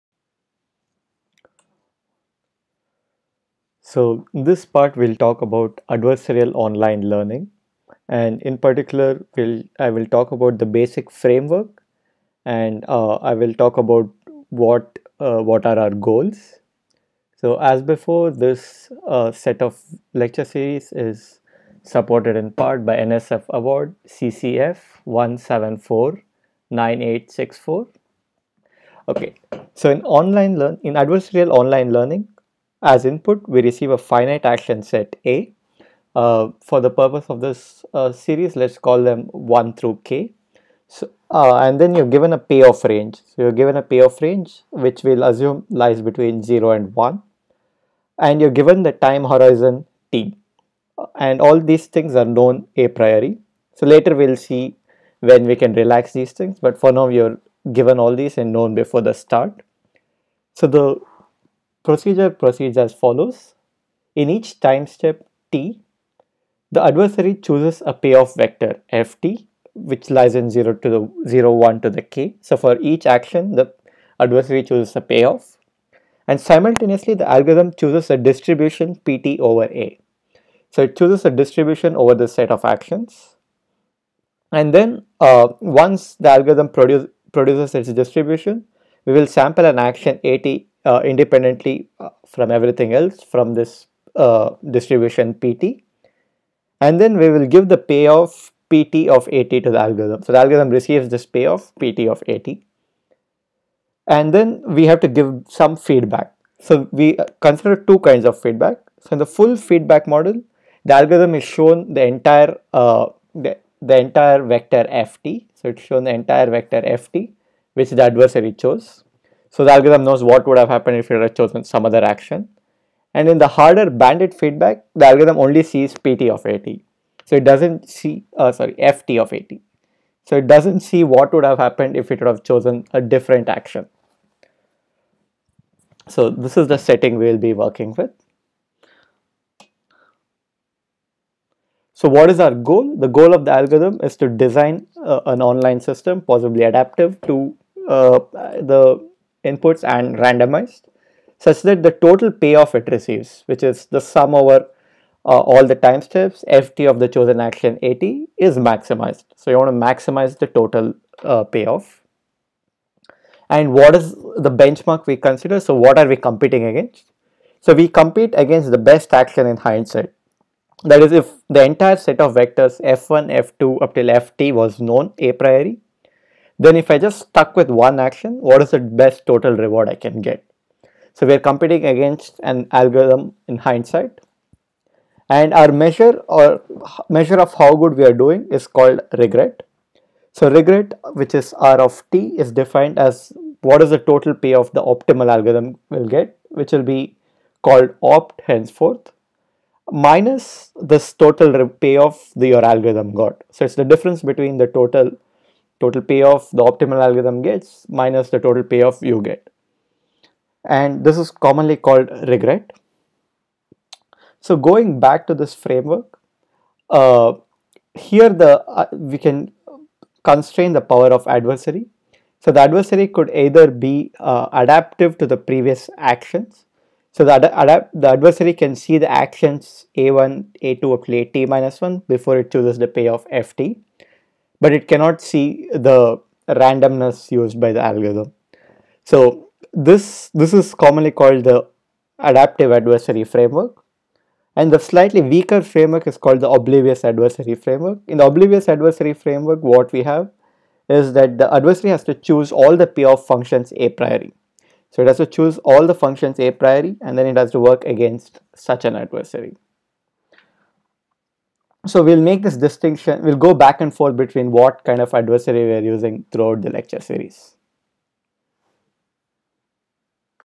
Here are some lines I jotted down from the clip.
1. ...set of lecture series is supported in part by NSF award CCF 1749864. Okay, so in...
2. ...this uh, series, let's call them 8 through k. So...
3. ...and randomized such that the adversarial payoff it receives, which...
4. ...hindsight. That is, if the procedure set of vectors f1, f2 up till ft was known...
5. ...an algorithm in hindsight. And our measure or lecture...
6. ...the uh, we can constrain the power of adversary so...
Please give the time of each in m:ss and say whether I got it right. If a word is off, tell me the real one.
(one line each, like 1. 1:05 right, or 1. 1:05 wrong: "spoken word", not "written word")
1. 0:19 right
2. 0:37 wrong: "1", not "8"
3. 2:29 wrong: "total", not "adversarial"
4. 2:49 wrong: "entire", not "procedure"
5. 3:02 wrong: "measure", not "lecture"
6. 3:38 right.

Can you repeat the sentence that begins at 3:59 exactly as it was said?
So this, this is commonly called the adaptive adversary framework and the slightly weaker framework is called the oblivious adversary framework.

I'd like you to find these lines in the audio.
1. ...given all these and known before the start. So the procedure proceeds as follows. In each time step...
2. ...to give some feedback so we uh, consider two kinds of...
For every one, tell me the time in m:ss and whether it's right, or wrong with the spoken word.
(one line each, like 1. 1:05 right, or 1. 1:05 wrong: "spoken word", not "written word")
1. 0:57 right
2. 1:45 right.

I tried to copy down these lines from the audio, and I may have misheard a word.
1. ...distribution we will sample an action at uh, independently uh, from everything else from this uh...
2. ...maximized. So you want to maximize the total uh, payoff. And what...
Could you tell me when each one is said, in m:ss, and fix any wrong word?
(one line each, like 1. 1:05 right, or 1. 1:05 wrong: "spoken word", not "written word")
1. 1:27 right
2. 2:38 right.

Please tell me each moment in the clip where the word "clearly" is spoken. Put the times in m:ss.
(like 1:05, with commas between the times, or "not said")
not said.